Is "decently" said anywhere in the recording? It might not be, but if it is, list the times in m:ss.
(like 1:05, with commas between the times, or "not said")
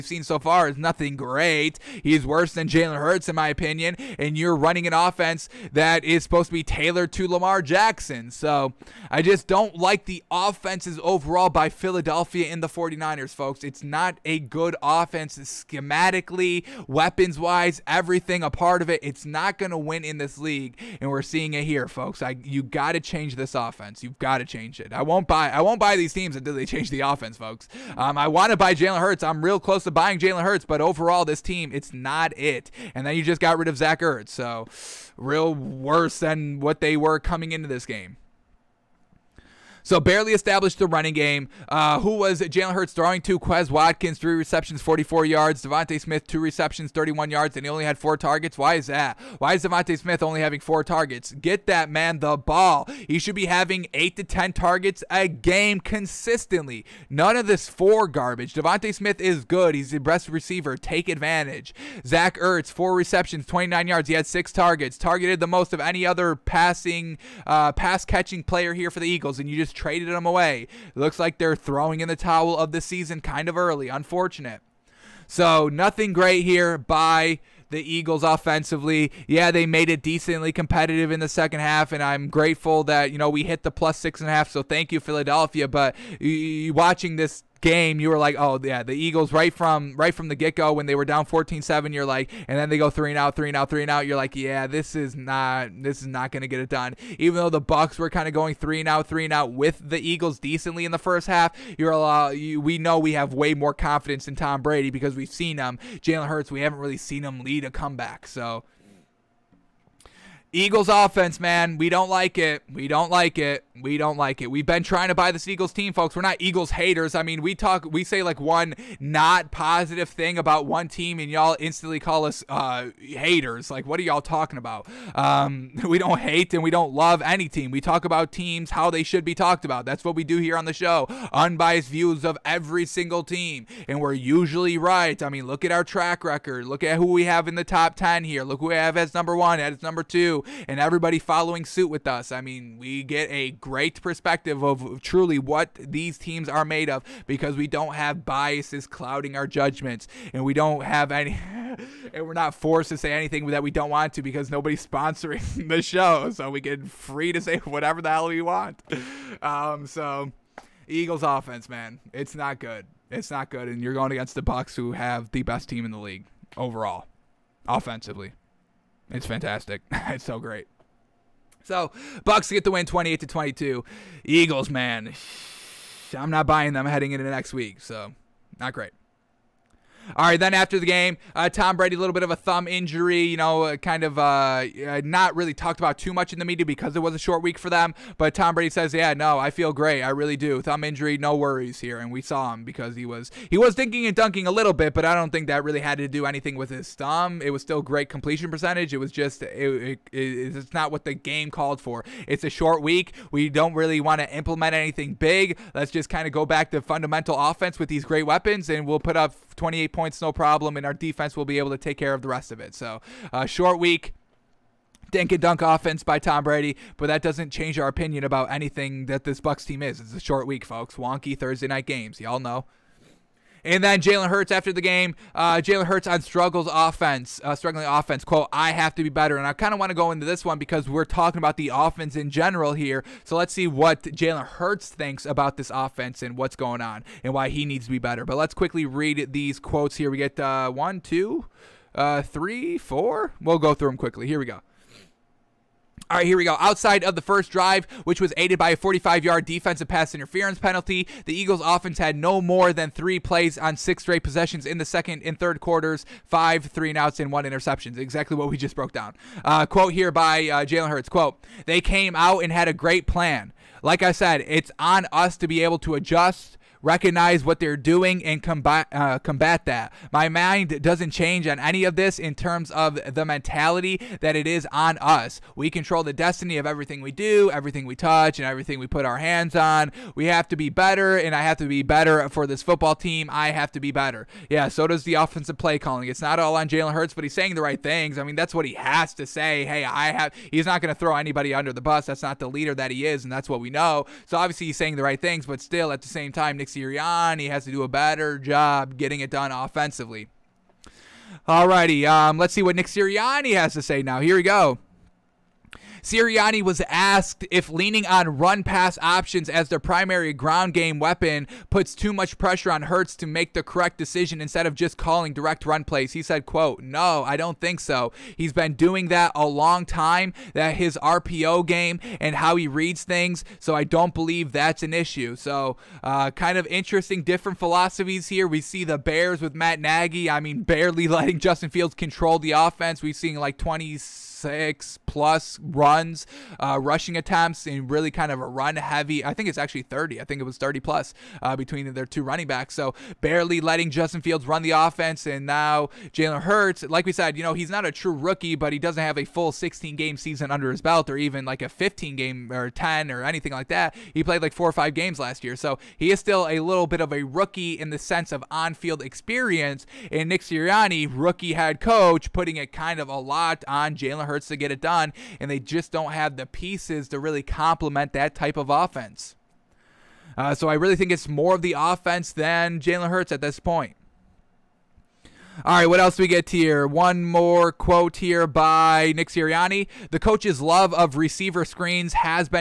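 1:20, 1:40.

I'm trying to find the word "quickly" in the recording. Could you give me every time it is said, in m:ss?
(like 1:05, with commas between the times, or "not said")
3:58, 4:03.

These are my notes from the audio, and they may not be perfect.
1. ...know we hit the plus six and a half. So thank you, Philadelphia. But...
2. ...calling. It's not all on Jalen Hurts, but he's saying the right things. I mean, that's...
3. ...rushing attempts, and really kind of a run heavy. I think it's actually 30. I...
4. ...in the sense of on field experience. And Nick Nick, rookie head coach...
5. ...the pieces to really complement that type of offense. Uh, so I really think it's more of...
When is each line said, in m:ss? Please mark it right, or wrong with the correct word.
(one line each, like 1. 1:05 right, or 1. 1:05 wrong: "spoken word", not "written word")
1. 1:23 right
2. 4:45 right
3. 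5:36 right
4. 5:57 wrong: "Sirianni", not "Nick"
5. 6:06 right.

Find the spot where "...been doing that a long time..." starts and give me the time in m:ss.
5:18.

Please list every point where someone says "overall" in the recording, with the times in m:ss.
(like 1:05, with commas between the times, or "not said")
0:11, 0:30, 2:46.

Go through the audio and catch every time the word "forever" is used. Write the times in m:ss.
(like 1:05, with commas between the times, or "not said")
not said.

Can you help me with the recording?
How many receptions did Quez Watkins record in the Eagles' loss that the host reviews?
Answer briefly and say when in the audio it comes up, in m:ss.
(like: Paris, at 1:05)
3, at 0:44.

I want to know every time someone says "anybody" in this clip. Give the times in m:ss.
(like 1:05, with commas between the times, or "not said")
4:51.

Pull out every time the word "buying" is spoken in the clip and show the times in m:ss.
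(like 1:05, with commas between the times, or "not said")
0:29, 2:56.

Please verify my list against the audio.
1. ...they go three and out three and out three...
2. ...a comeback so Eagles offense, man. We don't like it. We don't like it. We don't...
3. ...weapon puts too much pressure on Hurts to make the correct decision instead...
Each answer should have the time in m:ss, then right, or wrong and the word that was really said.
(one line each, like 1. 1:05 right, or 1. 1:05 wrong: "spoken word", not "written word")
1. 1:32 right
2. 1:47 right
3. 5:10 right.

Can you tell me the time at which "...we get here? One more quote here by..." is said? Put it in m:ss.
6:16.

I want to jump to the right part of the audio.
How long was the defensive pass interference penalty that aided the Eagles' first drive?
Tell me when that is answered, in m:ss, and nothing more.
4:08.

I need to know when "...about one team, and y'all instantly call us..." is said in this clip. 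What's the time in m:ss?
2:00.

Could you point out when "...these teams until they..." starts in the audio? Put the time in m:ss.
0:25.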